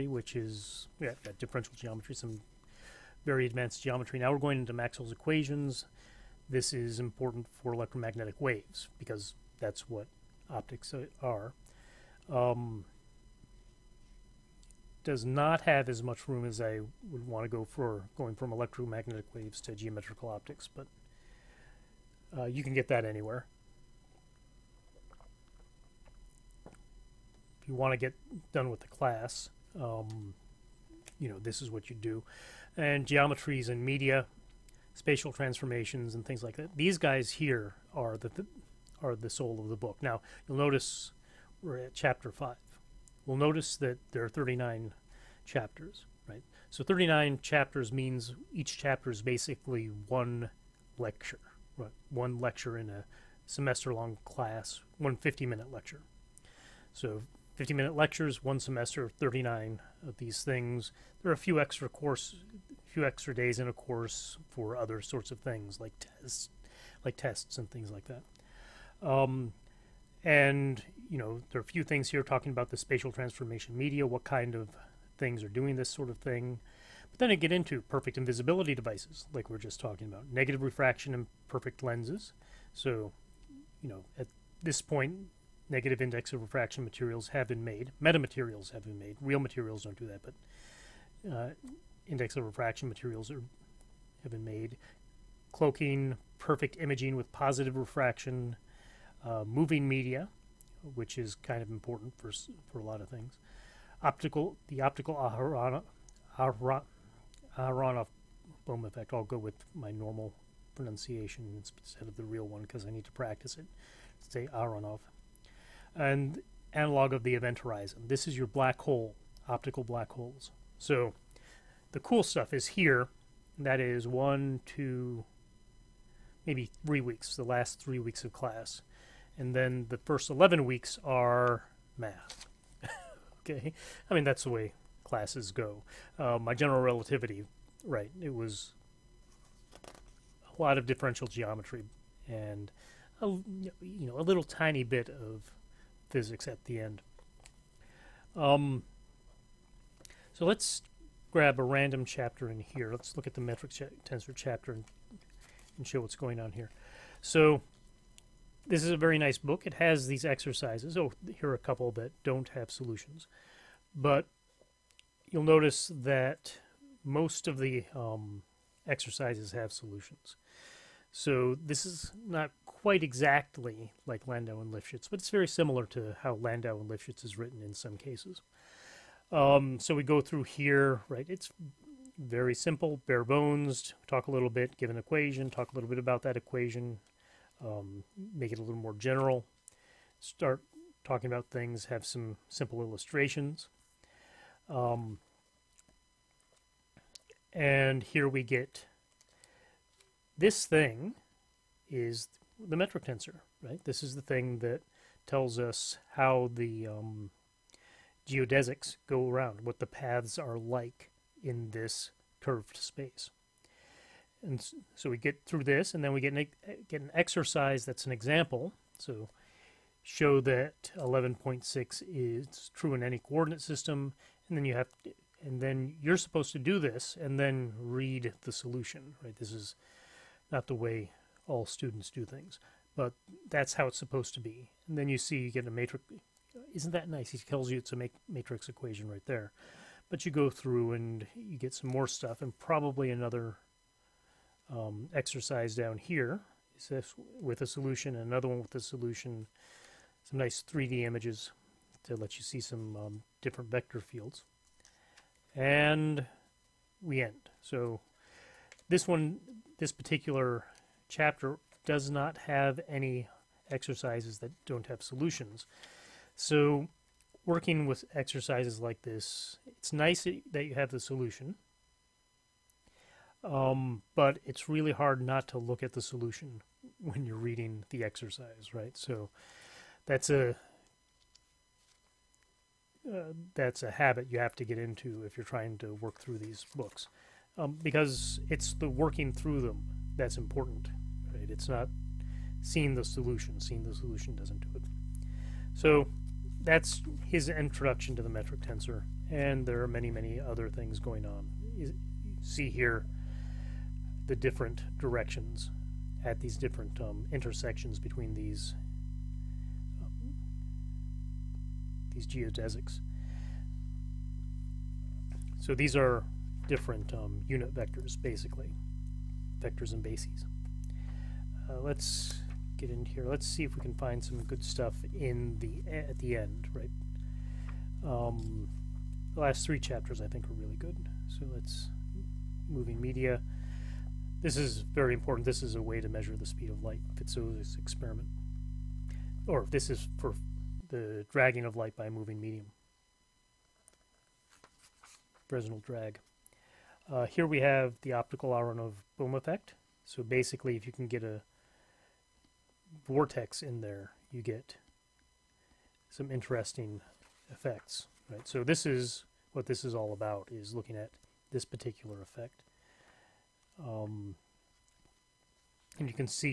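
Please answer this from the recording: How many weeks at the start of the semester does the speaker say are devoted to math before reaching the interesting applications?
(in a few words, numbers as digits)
11.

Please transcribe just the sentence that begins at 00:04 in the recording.
Now we're going into Maxwell's equations, this is important for electromagnetic waves because that's what optics are.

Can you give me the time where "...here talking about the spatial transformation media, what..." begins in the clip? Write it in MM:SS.
01:12.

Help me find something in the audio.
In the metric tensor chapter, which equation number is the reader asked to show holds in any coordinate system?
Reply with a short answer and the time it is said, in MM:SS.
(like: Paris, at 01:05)
11.6, at 03:40.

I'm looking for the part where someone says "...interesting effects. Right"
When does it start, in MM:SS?
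05:56.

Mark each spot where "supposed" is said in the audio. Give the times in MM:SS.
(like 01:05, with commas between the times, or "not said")
03:46, 03:53.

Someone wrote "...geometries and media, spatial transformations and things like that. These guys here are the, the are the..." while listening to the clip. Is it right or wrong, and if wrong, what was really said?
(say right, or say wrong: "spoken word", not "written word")
right.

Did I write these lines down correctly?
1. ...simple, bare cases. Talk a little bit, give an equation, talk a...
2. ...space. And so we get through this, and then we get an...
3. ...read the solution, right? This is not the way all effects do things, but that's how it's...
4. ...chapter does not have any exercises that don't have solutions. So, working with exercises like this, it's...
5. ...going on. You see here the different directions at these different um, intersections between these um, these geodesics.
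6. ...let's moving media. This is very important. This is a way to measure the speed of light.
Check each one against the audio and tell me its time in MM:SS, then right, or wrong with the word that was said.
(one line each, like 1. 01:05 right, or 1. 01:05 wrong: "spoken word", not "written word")
1. 03:02 wrong: "bones", not "cases"
2. 03:32 right
3. 03:47 wrong: "students", not "effects"
4. 04:21 right
5. 05:00 right
6. 05:31 right.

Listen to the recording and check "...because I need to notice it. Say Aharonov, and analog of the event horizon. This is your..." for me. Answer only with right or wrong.
wrong.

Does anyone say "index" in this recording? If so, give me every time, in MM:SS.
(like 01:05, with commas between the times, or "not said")
01:26, 01:32.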